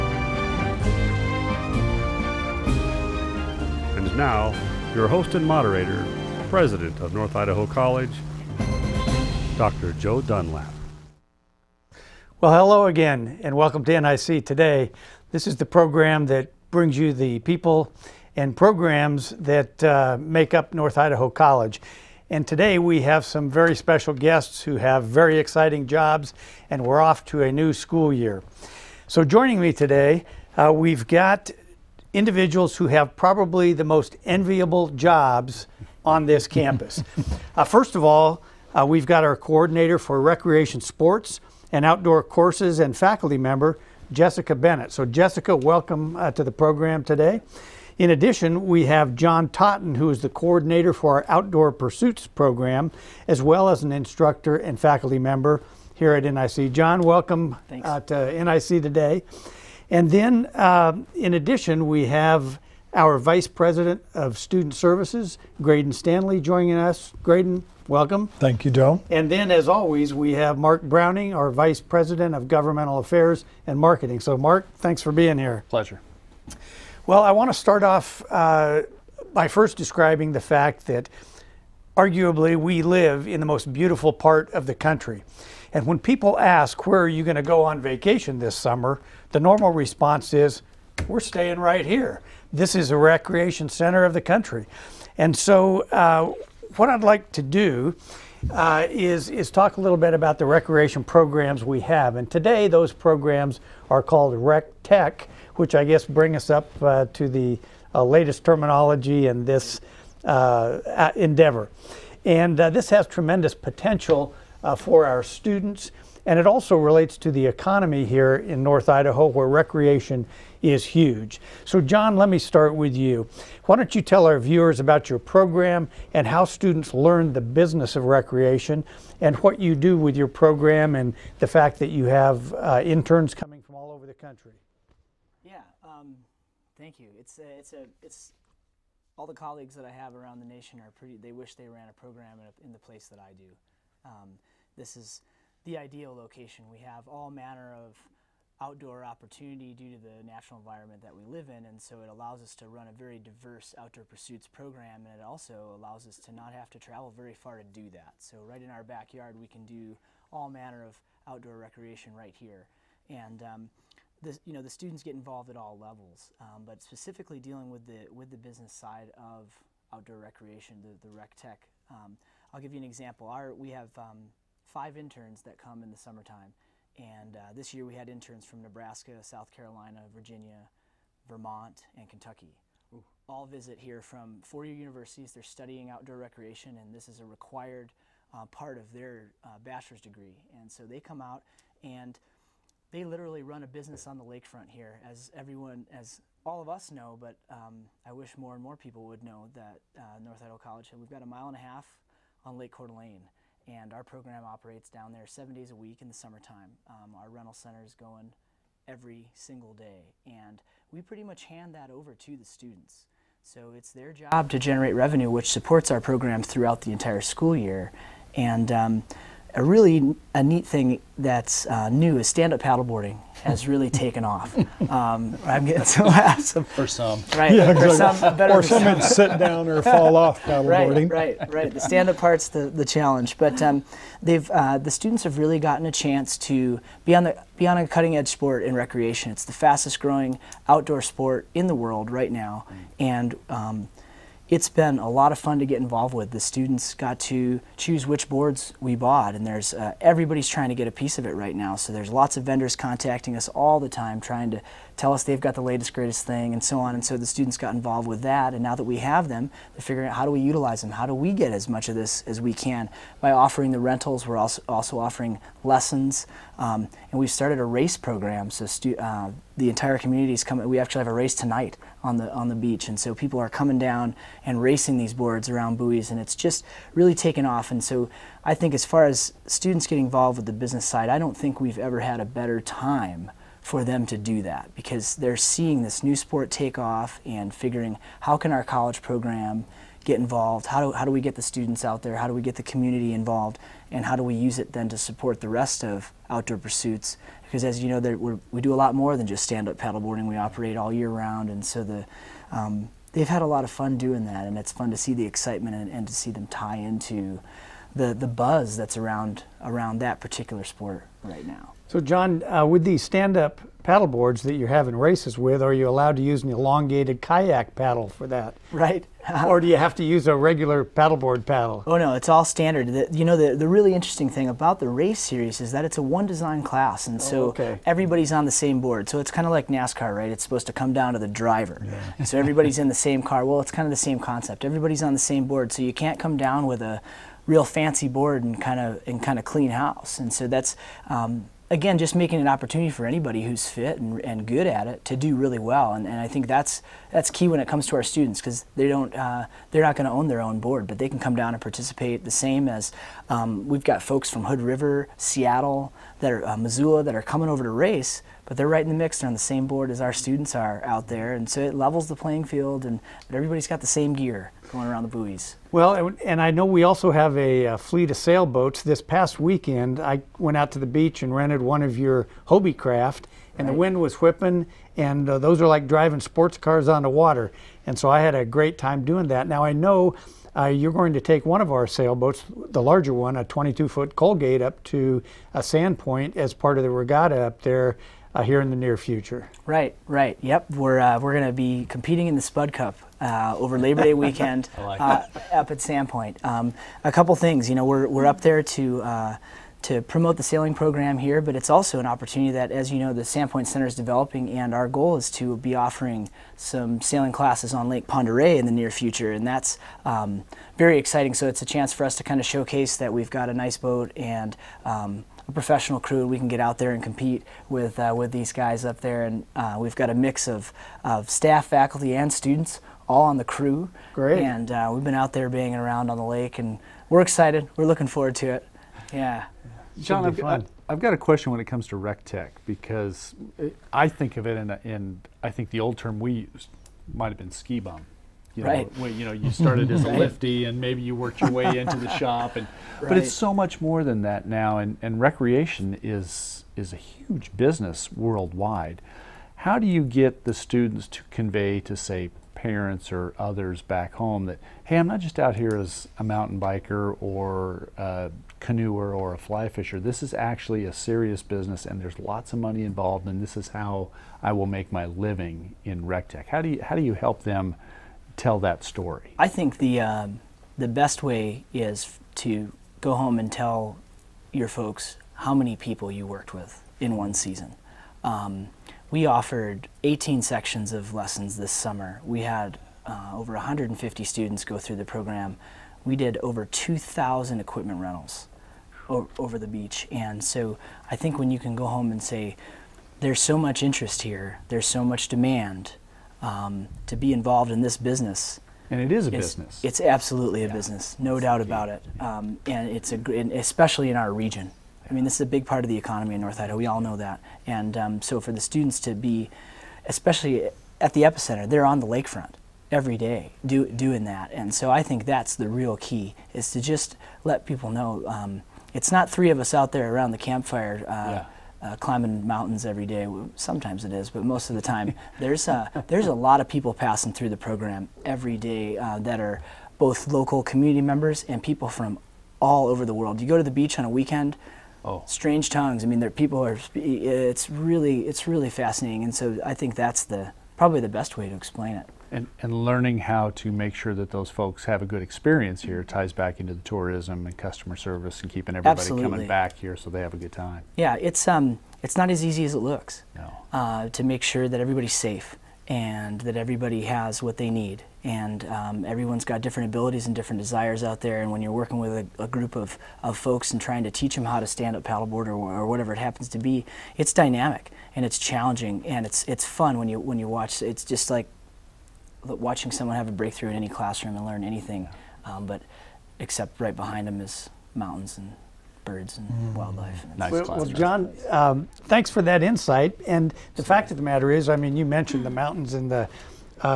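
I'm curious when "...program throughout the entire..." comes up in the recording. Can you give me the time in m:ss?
3:35.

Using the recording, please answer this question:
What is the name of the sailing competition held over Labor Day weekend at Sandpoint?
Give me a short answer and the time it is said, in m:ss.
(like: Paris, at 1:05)
Spud Cup, at 6:32.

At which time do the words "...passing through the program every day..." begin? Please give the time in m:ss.
8:46.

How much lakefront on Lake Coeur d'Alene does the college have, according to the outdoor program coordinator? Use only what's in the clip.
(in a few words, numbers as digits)
A mile and a half.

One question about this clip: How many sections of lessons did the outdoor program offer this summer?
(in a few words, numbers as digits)
18.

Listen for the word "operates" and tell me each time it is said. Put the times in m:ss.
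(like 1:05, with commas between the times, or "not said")
3:24, 5:00.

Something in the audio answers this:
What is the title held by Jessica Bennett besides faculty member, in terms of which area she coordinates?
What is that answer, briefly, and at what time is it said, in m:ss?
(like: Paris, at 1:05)
Recreation sports and outdoor courses, at 0:40.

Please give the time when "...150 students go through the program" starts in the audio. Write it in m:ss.
8:03.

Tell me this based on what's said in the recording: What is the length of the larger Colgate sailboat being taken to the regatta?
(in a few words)
22 foot.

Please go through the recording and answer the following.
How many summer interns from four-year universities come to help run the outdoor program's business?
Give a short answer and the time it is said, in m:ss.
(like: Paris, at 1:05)
5, at 2:54.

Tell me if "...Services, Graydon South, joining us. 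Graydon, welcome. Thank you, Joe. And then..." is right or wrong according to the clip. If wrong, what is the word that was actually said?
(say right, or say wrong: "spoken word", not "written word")
wrong: "Stanley", not "South".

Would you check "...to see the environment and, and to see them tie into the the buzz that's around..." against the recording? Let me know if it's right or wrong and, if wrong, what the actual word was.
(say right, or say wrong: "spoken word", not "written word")
wrong: "excitement", not "environment".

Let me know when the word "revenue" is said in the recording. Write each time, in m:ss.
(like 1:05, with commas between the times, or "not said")
3:34.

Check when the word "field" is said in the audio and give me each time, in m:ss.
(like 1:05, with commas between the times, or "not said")
6:02.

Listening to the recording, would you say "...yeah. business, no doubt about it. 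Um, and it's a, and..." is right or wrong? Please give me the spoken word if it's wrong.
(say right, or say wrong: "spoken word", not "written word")
right.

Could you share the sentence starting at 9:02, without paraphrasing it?
And, and learning how to make sure that those folks have a good experience here mm-hmm.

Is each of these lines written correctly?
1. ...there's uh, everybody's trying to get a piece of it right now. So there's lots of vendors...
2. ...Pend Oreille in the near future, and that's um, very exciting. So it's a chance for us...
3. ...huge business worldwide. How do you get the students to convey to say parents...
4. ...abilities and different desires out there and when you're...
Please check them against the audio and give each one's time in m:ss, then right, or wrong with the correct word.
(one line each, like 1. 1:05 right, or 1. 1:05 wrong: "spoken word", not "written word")
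1. 4:09 right
2. 6:48 right
3. 7:26 right
4. 9:19 right.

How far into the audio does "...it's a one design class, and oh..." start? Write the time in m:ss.
5:25.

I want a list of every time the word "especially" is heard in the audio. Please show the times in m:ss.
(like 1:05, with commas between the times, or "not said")
8:23, 8:30.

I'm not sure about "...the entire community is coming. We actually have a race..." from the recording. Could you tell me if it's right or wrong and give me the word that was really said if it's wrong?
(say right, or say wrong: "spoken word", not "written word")
right.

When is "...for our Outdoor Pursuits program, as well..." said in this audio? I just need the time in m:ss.
0:50.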